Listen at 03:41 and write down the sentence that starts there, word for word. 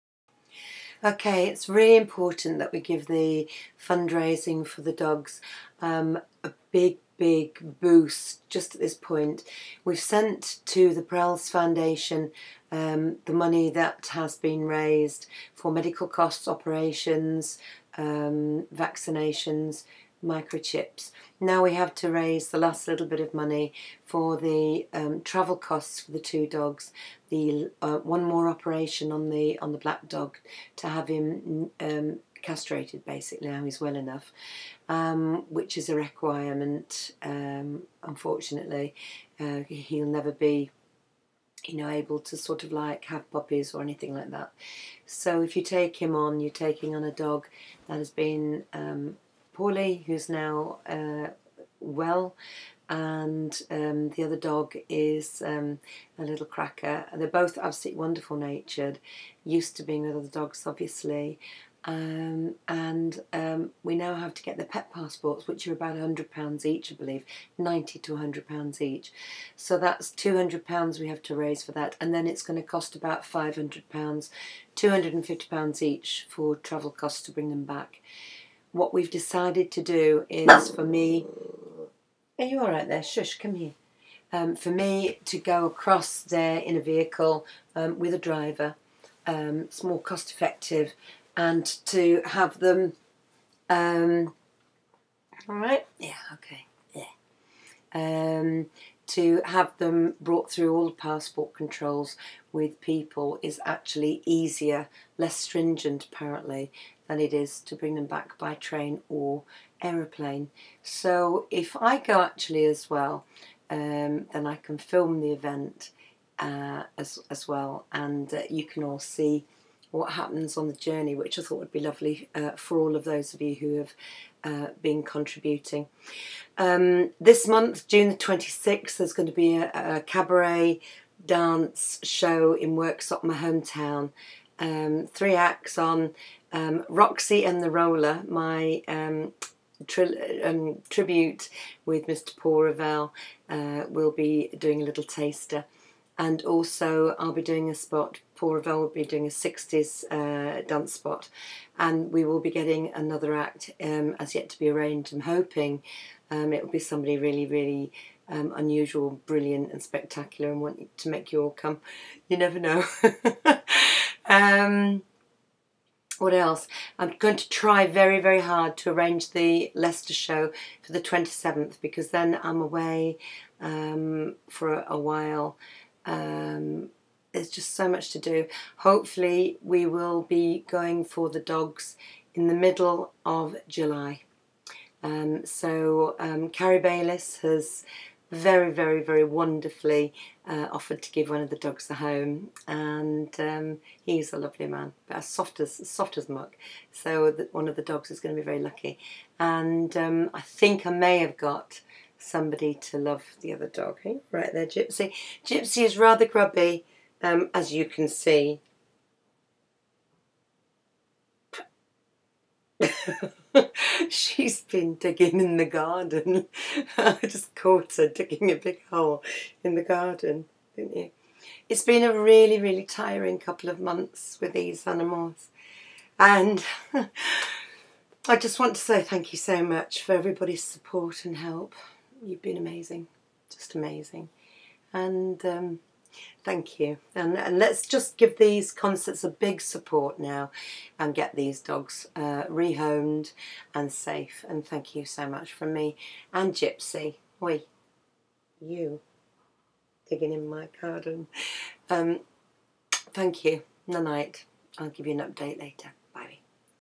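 It's been a really, really tiring couple of months with these animals.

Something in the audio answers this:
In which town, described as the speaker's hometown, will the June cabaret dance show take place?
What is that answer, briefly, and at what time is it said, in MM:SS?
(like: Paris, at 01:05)
Worksop, at 02:12.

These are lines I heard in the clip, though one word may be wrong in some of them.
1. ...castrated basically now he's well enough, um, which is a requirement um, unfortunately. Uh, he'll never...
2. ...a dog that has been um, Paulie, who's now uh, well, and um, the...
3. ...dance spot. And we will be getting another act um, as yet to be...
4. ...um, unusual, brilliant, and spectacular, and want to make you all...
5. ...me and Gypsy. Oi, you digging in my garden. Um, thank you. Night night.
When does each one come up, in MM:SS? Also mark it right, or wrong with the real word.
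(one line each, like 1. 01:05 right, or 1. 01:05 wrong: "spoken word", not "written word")
1. 00:32 right
2. 00:47 right
3. 02:30 right
4. 02:38 right
5. 04:05 right.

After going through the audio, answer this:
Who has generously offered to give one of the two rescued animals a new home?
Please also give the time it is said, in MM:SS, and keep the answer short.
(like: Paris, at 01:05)
Carrie Bayliss, at 03:06.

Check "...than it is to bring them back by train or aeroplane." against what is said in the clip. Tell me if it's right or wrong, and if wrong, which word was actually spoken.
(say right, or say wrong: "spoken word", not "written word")
right.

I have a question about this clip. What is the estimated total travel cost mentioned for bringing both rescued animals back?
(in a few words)
£500.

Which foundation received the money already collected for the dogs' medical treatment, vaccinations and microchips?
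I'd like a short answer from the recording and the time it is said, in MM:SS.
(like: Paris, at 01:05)
Prelz Foundation, at 00:11.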